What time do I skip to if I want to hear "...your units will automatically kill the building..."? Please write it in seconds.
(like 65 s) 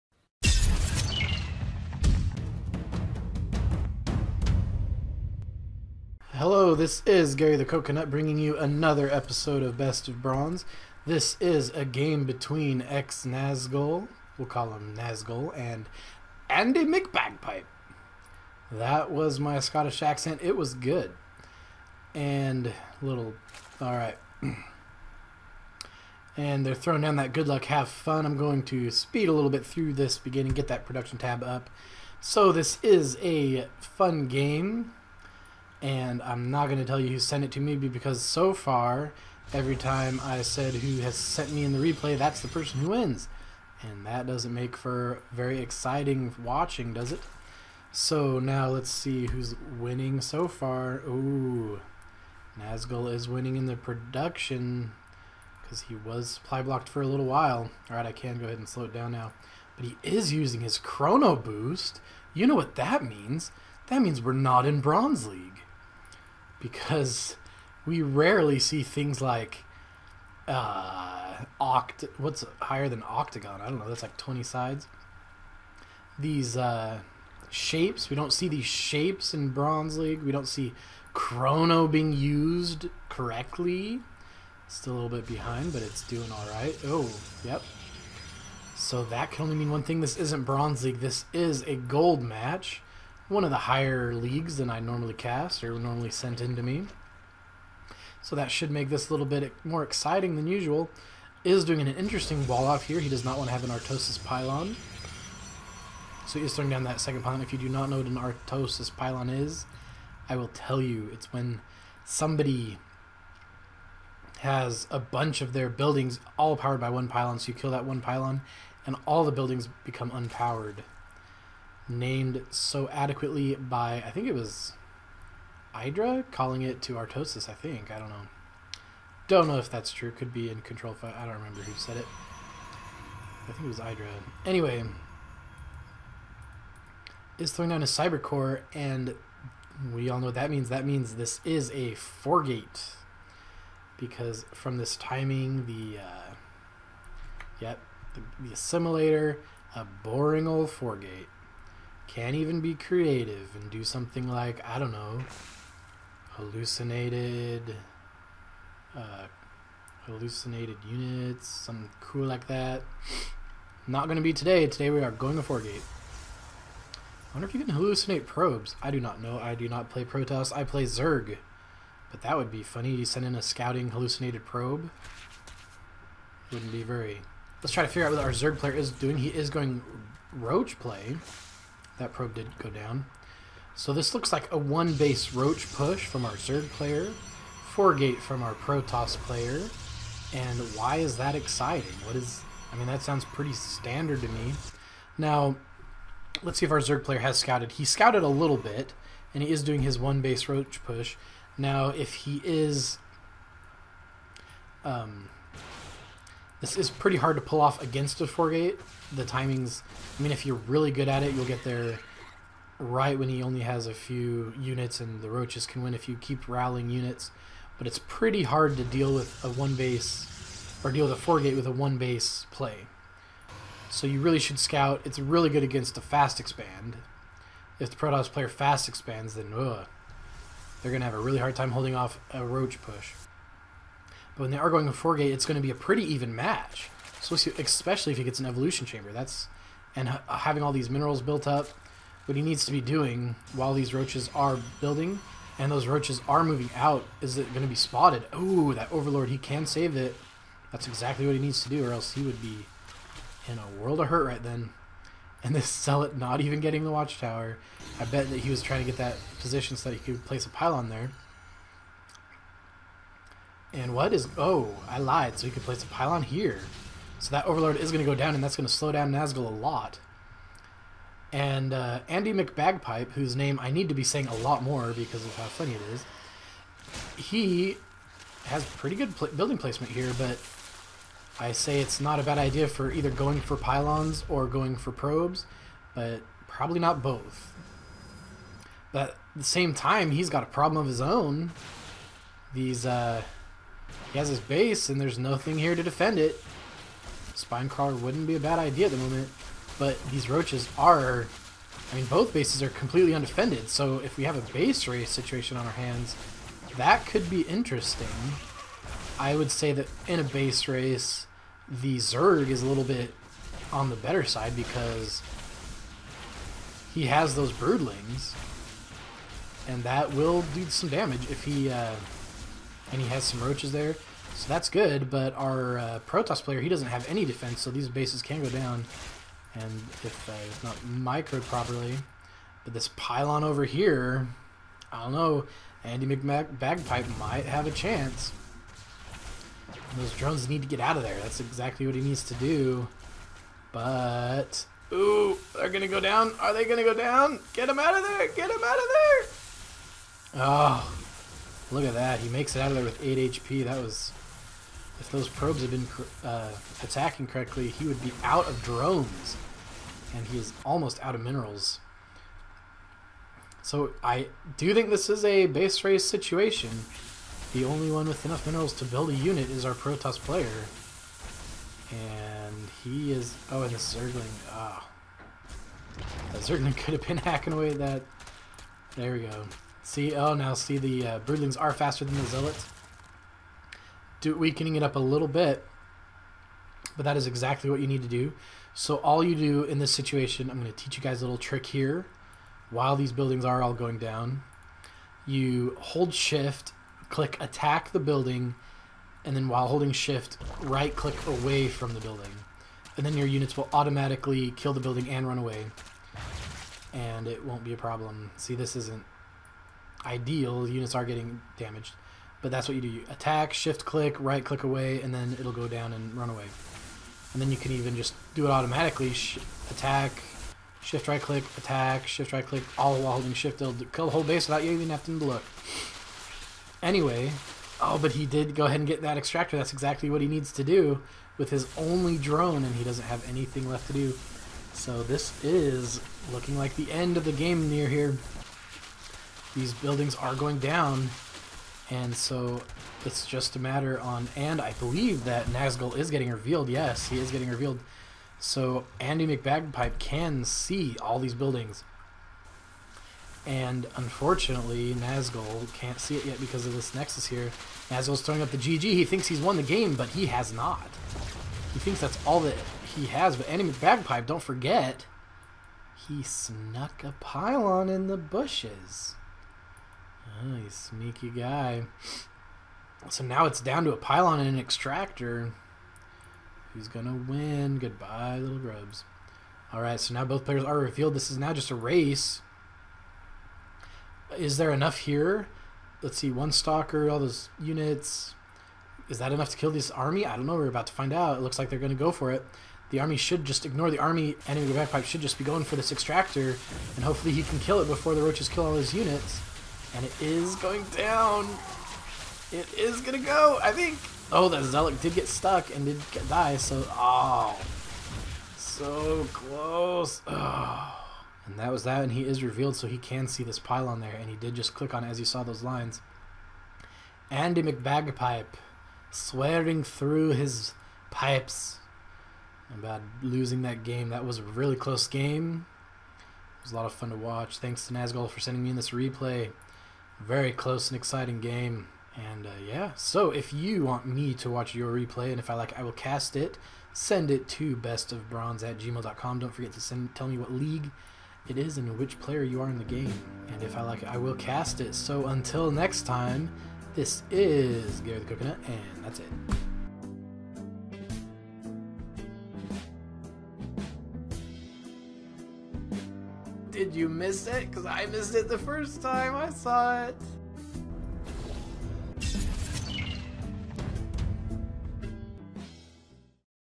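403 s.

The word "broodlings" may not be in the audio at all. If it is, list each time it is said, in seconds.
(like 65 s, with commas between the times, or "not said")
317 s, 381 s.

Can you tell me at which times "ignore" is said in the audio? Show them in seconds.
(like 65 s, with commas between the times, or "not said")
493 s.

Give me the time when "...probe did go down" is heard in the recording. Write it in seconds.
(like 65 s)
182 s.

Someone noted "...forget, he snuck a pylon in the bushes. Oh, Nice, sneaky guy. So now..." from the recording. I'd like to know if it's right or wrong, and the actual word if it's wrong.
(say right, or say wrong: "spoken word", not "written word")
right.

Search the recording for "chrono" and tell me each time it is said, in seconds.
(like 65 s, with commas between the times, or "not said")
60 s, 81 s.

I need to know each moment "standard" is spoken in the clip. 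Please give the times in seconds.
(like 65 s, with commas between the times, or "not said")
193 s.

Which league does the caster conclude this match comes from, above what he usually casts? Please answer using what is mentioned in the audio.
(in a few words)
Gold.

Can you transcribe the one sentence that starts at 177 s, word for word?
Let's try to figure out what our Zerg player is doing.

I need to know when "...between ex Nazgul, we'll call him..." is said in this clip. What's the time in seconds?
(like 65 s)
12 s.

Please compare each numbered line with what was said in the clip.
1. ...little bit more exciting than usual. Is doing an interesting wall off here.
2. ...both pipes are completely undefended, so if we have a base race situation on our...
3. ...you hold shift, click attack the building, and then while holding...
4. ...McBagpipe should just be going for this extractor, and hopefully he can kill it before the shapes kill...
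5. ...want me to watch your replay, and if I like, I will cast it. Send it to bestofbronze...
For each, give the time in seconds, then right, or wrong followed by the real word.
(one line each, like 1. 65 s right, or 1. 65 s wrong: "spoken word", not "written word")
1. 99 s right
2. 302 s wrong: "bases", not "pipes"
3. 395 s right
4. 494 s wrong: "roaches", not "shapes"
5. 533 s right.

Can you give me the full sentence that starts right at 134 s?
Anyway, is throwing down a cyber core, and we all know what that means.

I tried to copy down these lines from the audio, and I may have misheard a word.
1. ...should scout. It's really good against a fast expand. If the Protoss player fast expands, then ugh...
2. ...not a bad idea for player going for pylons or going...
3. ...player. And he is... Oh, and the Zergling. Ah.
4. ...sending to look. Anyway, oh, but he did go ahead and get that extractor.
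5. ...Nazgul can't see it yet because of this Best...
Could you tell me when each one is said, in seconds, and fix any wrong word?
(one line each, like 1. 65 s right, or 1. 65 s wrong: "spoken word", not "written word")
1. 224 s right
2. 282 s wrong: "either", not "player"
3. 370 s right
4. 424 s wrong: "having", not "sending"
5. 454 s wrong: "Nexus", not "Best".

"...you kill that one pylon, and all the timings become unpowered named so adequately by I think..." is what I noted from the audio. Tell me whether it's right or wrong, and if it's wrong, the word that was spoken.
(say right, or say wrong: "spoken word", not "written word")
wrong: "buildings", not "timings".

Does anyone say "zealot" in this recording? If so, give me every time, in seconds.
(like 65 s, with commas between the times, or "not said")
255 s, 382 s, 504 s.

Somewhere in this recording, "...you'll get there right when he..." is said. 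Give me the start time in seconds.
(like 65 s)
211 s.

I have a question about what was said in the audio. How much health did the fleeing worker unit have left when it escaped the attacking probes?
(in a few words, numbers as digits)
8 HP.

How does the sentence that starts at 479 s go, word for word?
All right, so now both players are revealed.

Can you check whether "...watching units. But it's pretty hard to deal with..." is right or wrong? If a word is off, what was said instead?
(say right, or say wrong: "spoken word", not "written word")
wrong: "rallying", not "watching".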